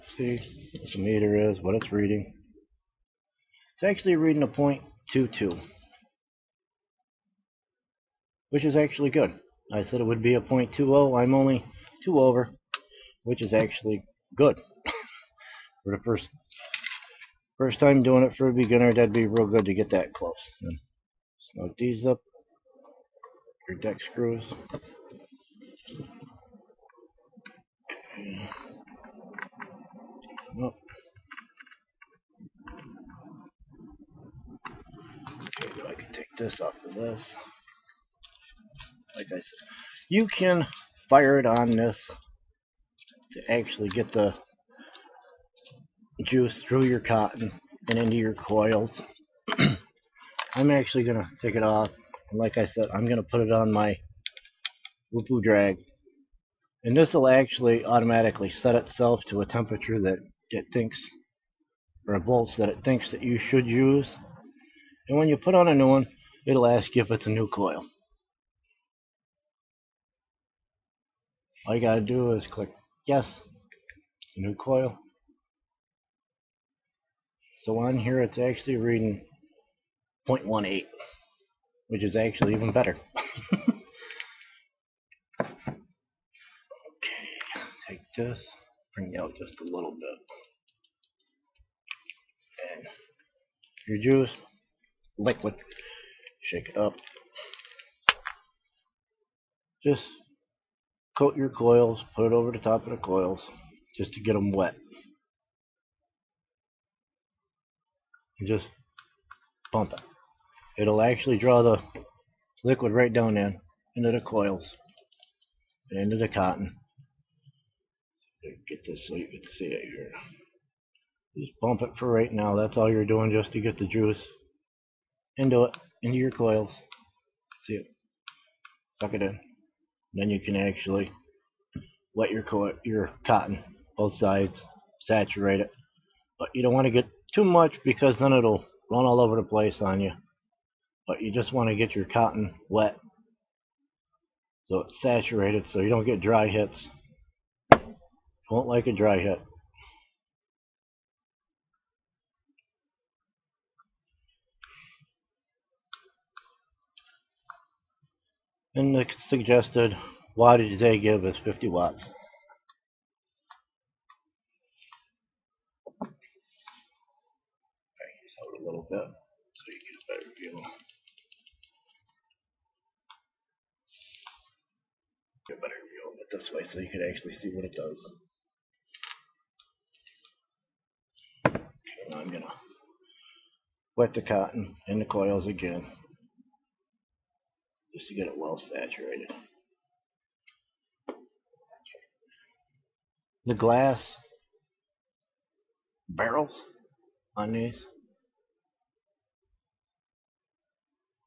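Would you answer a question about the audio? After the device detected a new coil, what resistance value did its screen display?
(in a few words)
0.18.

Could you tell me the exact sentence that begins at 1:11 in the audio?
All you gotta do is click Yes, a new coil.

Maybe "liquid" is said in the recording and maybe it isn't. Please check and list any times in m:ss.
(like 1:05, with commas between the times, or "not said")
1:35, 1:52.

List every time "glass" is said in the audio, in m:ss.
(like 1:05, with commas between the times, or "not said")
3:13.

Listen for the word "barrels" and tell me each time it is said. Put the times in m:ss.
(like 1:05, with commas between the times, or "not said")
3:16.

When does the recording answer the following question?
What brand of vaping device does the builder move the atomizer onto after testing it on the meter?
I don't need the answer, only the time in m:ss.
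0:55.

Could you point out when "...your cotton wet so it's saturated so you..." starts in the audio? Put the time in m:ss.
2:21.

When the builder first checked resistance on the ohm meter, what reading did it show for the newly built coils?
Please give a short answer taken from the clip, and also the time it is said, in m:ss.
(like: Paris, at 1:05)
0.22, at 0:04.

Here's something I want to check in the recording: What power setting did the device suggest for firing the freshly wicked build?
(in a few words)
50 watts.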